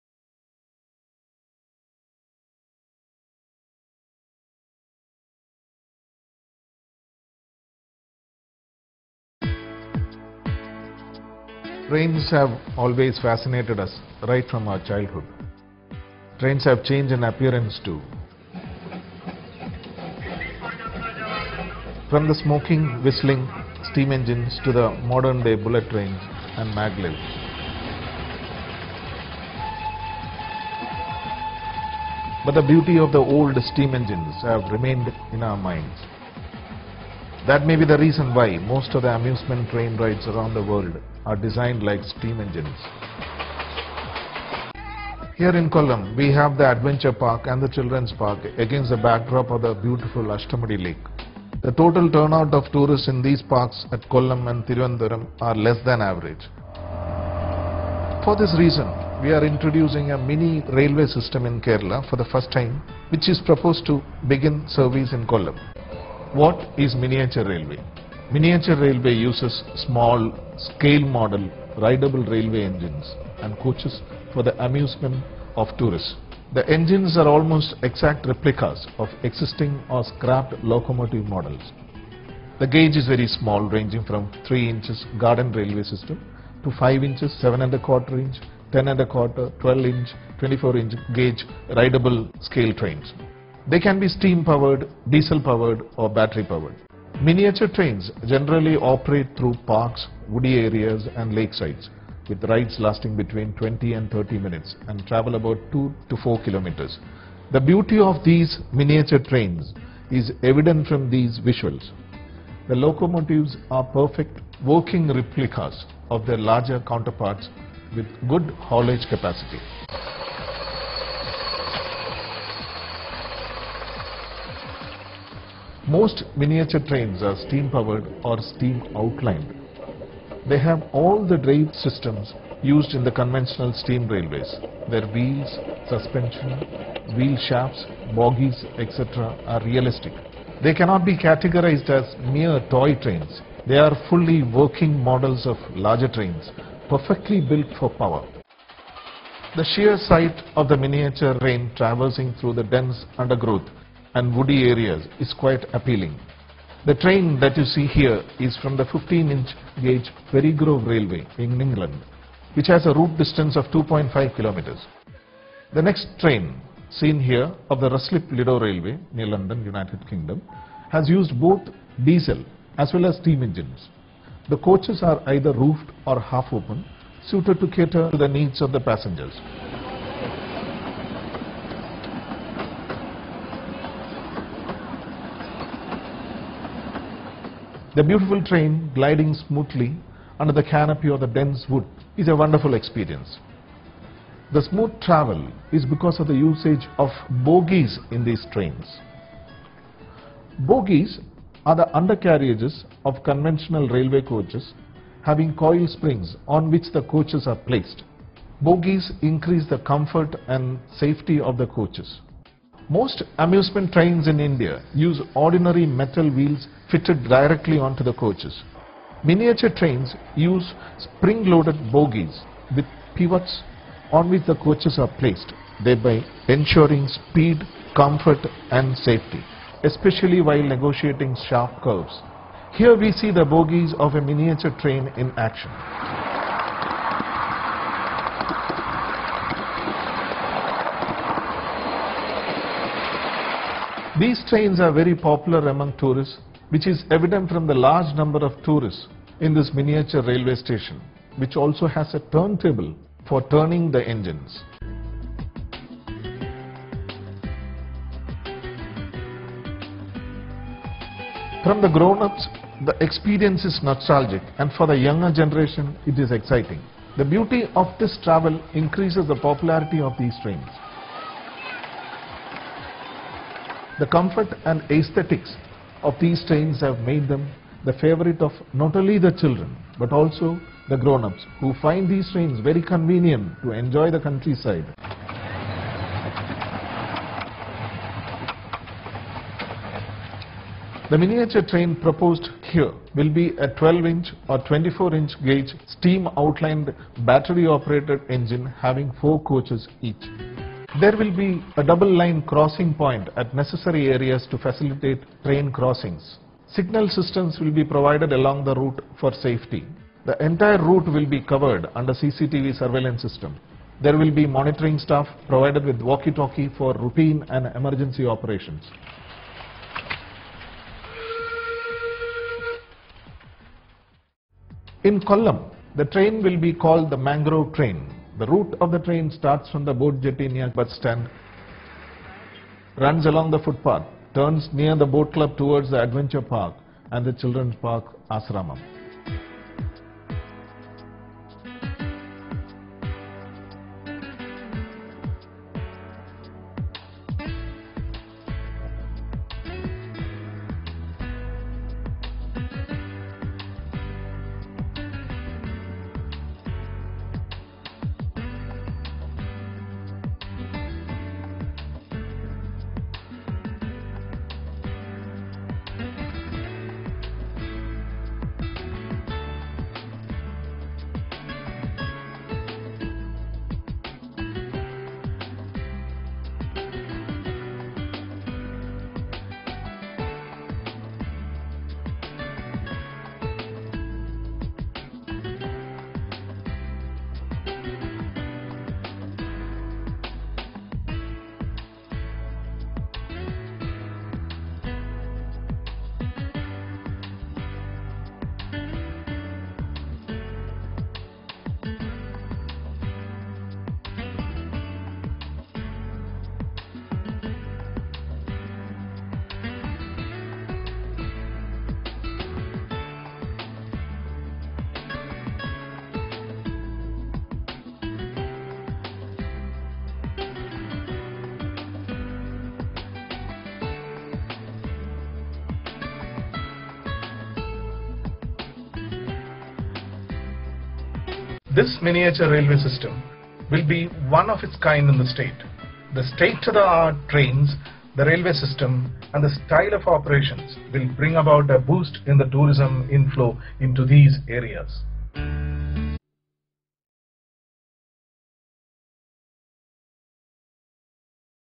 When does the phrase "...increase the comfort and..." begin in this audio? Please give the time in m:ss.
3:29.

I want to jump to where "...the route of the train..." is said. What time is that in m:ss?
5:28.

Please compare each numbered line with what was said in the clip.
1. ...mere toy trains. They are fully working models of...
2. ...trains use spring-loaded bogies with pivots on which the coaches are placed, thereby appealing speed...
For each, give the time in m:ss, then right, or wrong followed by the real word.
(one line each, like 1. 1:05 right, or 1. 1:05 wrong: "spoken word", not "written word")
1. 2:22 right
2. 3:39 wrong: "ensuring", not "appealing".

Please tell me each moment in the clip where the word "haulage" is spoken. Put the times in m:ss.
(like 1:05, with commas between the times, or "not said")
1:58.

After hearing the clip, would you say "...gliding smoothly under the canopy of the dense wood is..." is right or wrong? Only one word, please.
right.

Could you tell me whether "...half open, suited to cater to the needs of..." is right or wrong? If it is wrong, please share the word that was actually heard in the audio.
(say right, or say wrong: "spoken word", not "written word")
right.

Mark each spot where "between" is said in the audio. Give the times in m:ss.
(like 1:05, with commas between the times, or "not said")
1:43.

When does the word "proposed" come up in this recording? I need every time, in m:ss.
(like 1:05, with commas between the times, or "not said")
1:03, 4:52.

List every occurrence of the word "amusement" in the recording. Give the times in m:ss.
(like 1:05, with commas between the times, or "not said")
0:39, 1:14, 3:33.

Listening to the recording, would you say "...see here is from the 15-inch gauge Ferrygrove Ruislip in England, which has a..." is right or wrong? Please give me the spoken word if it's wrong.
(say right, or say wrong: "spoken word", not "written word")
wrong: "Railway", not "Ruislip".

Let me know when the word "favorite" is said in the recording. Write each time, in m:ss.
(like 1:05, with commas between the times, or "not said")
4:37.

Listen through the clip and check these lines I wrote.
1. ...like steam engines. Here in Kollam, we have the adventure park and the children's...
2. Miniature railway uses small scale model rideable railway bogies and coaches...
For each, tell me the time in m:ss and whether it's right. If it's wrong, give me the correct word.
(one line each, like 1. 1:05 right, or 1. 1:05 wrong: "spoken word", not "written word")
1. 0:41 right
2. 1:08 wrong: "engines", not "bogies".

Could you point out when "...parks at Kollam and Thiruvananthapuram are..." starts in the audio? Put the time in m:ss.
0:53.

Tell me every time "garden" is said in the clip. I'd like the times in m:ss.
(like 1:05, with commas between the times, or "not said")
1:25.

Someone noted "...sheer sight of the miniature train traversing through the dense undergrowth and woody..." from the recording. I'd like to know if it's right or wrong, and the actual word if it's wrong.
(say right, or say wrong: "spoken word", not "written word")
right.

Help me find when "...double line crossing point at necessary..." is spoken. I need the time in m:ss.
5:01.